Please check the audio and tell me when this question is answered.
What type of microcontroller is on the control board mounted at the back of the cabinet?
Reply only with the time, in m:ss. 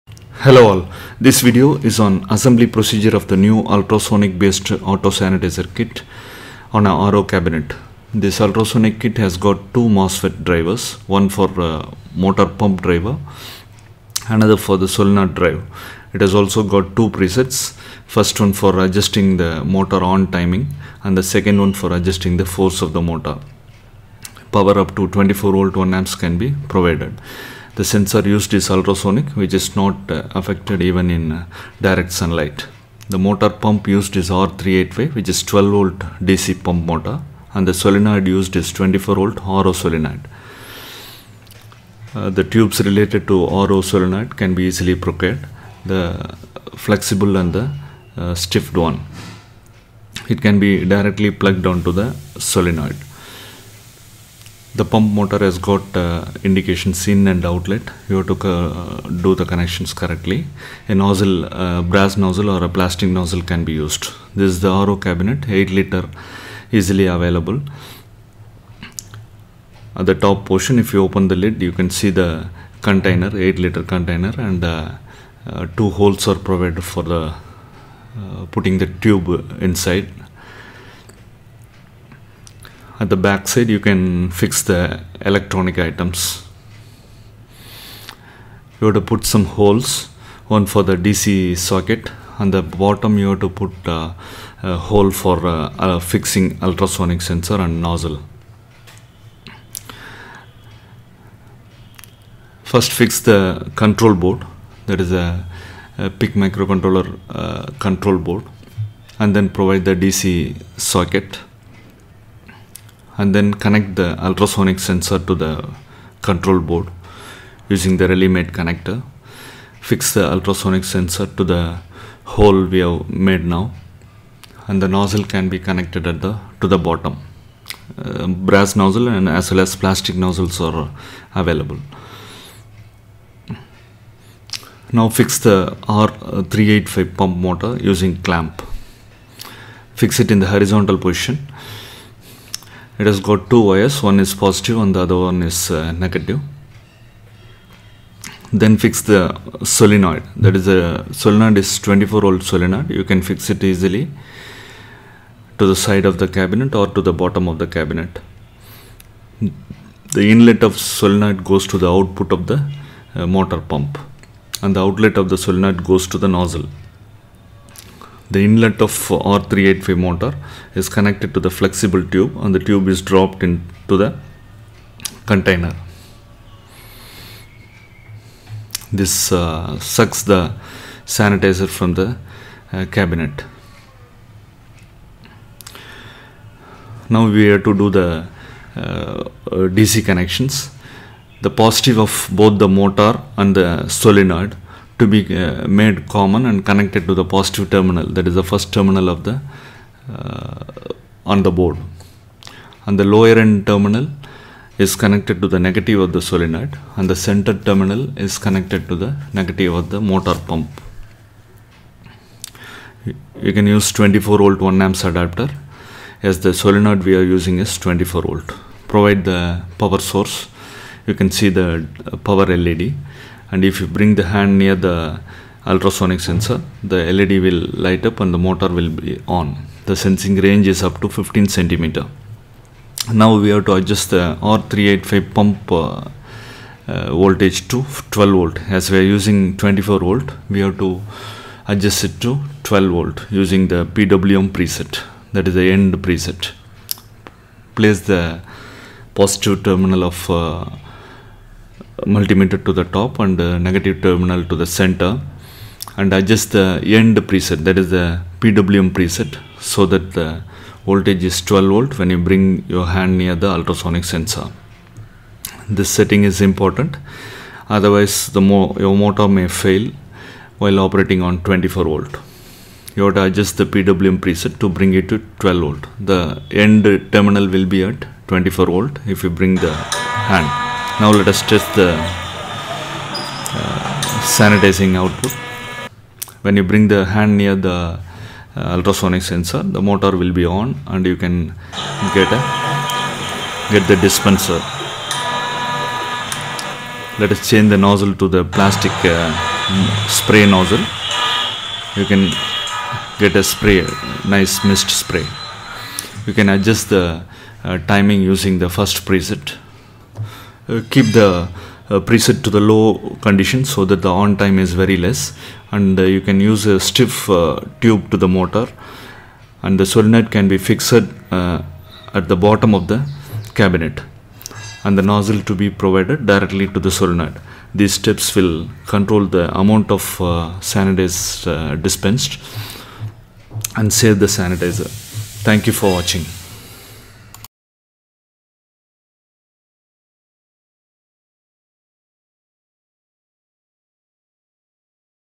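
1:46.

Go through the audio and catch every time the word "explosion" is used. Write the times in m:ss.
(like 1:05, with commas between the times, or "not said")
not said.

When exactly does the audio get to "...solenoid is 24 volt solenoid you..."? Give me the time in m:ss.
2:31.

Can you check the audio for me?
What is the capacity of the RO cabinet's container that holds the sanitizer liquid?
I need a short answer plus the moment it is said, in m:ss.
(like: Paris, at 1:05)
8 liter, at 1:05.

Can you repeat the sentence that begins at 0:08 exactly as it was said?
This ultrasonic kit has got two MOSFET drivers, one for uh, motor pump driver, another for the solenoid drive.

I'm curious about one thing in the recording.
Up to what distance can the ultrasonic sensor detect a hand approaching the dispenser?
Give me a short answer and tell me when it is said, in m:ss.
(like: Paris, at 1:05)
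15 centimeters, at 3:51.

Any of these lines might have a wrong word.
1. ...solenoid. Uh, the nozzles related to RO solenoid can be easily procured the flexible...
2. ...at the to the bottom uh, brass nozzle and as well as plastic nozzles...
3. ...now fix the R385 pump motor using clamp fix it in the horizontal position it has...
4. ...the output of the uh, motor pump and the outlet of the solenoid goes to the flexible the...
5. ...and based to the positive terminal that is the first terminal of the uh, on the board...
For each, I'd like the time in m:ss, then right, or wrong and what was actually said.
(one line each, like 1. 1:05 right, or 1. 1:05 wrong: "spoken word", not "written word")
1. 0:39 wrong: "tubes", not "nozzles"
2. 2:06 right
3. 2:14 right
4. 2:41 wrong: "nozzle", not "flexible"
5. 3:16 wrong: "connected", not "based".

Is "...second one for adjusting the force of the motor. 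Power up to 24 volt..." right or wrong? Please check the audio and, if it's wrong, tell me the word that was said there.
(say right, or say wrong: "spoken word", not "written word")
right.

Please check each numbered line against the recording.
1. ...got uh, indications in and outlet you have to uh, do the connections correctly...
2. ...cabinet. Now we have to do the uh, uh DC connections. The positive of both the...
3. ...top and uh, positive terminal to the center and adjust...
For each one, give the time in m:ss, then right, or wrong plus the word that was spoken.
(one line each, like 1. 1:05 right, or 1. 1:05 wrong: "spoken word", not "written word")
1. 0:55 right
2. 3:02 right
3. 4:12 wrong: "negative", not "positive".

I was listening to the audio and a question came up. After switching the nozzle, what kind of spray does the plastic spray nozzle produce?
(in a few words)
nice mist spray.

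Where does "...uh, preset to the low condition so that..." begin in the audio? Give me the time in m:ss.
5:11.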